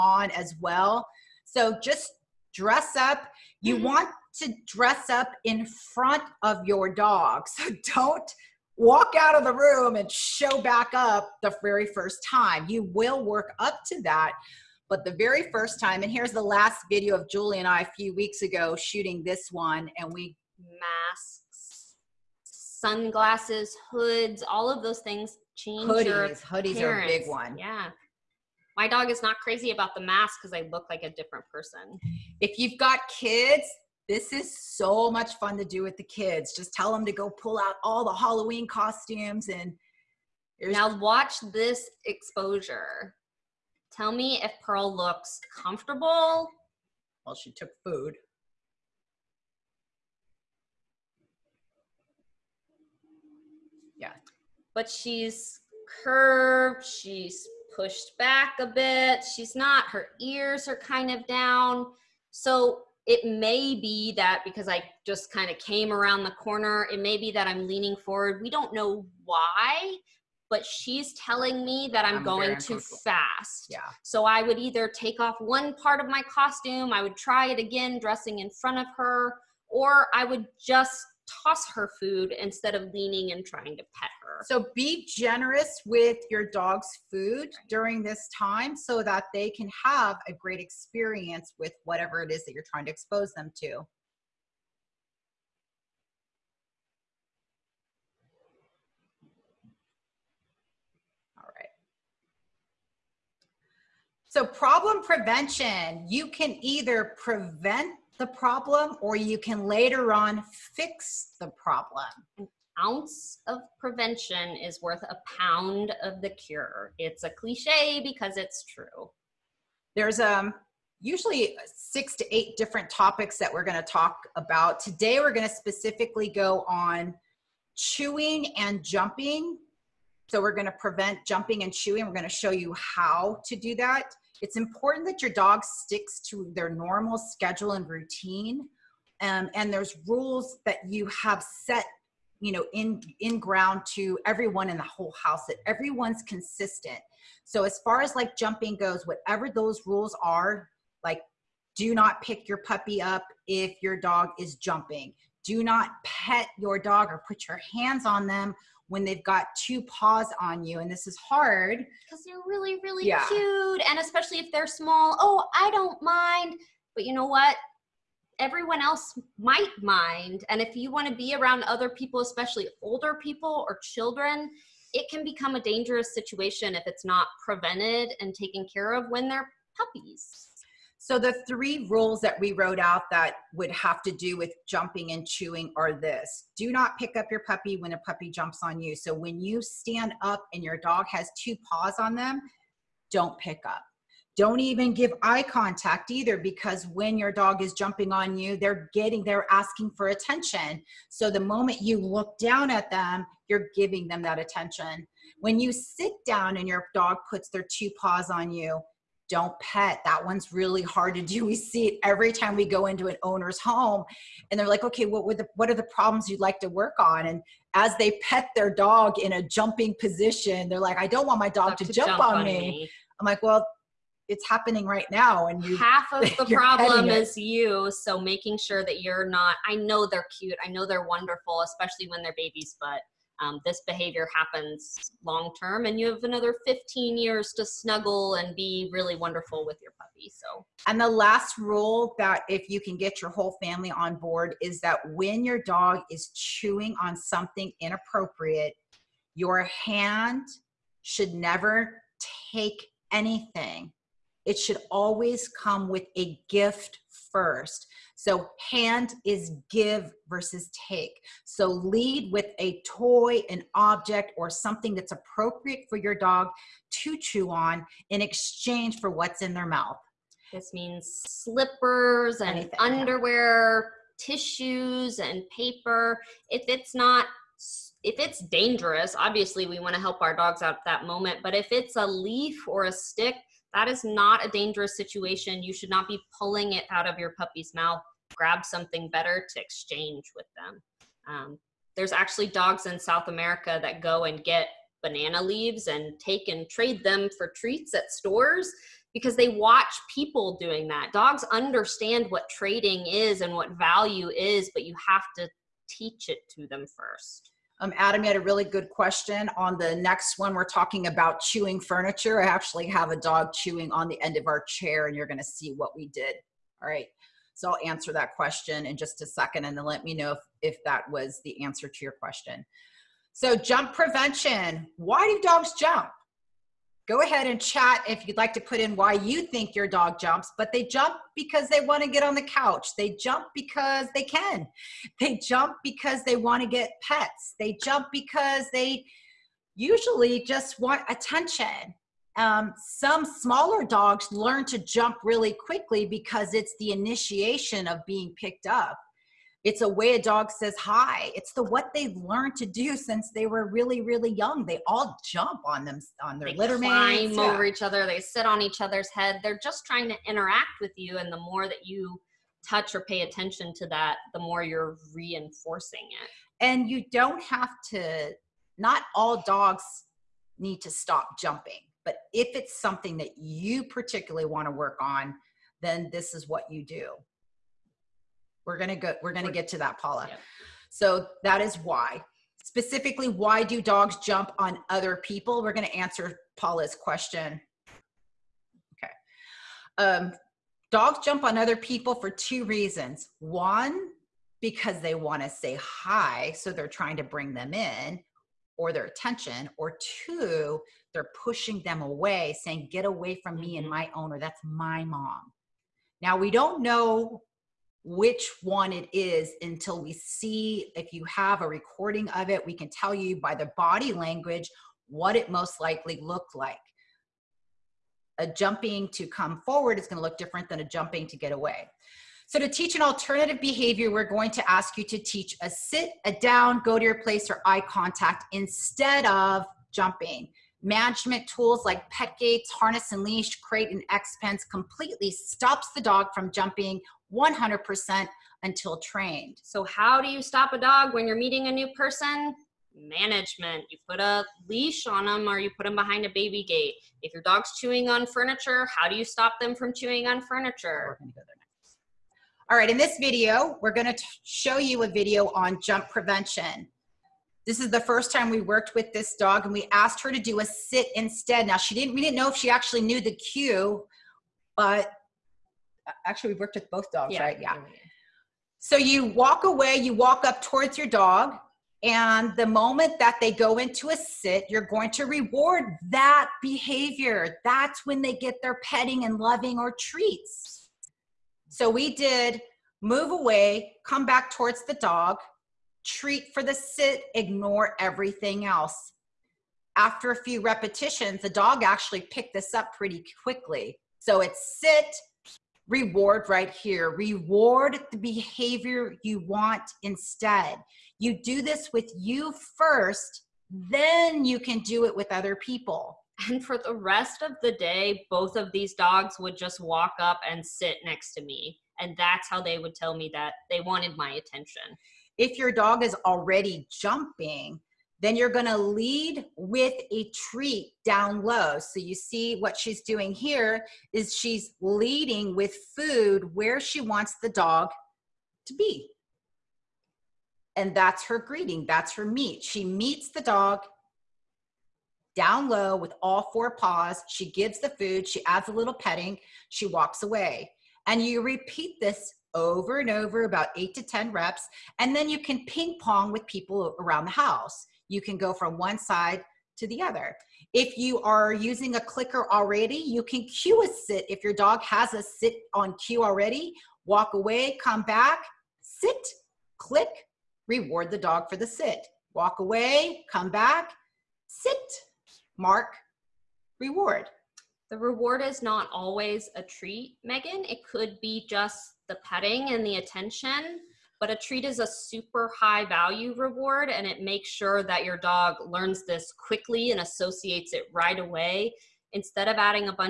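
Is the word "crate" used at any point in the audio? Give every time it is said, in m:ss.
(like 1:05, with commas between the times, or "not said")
7:13.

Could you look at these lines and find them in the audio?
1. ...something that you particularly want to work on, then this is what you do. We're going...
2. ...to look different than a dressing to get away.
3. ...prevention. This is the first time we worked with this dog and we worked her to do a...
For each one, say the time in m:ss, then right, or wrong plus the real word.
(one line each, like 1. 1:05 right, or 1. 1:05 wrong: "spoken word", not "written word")
1. 6:12 right
2. 7:00 wrong: "jumping", not "dressing"
3. 7:36 wrong: "asked", not "worked".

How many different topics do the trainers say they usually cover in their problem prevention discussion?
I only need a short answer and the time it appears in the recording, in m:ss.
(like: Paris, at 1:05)
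6 to 8, at 2:01.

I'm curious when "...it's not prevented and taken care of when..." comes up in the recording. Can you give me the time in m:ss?
2:56.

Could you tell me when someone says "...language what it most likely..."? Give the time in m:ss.
6:54.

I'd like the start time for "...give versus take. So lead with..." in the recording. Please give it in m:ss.
4:19.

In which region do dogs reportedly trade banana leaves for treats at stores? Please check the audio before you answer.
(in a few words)
South America.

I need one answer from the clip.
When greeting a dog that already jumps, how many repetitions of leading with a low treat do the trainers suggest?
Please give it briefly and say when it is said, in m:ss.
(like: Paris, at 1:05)
8 to 10, at 9:03.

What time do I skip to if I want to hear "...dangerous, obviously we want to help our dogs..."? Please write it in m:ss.
4:38.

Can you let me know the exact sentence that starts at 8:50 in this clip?
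And that's her greeting, that's her meet.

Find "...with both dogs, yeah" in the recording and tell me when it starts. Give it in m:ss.
7:46.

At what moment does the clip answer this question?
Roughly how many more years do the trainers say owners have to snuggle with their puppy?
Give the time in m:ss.
3:56.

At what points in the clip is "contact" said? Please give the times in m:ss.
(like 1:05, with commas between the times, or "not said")
3:15, 7:07.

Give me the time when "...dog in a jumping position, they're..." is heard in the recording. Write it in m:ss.
3:38.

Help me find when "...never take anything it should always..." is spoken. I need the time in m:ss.
4:11.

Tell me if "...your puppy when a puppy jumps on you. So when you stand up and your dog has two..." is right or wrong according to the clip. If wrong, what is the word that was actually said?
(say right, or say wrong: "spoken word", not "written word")
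right.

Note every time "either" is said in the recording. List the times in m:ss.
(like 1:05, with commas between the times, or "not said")
1:14, 1:46, 3:16.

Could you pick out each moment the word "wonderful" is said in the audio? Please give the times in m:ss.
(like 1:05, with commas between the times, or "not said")
3:51, 3:59.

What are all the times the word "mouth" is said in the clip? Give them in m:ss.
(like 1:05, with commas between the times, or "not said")
4:29, 4:47.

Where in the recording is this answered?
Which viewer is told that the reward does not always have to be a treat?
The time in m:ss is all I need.
9:30.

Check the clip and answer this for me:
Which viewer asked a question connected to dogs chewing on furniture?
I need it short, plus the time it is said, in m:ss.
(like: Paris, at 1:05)
Adam, at 5:07.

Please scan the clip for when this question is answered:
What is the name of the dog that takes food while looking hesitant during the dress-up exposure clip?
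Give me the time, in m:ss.
0:44.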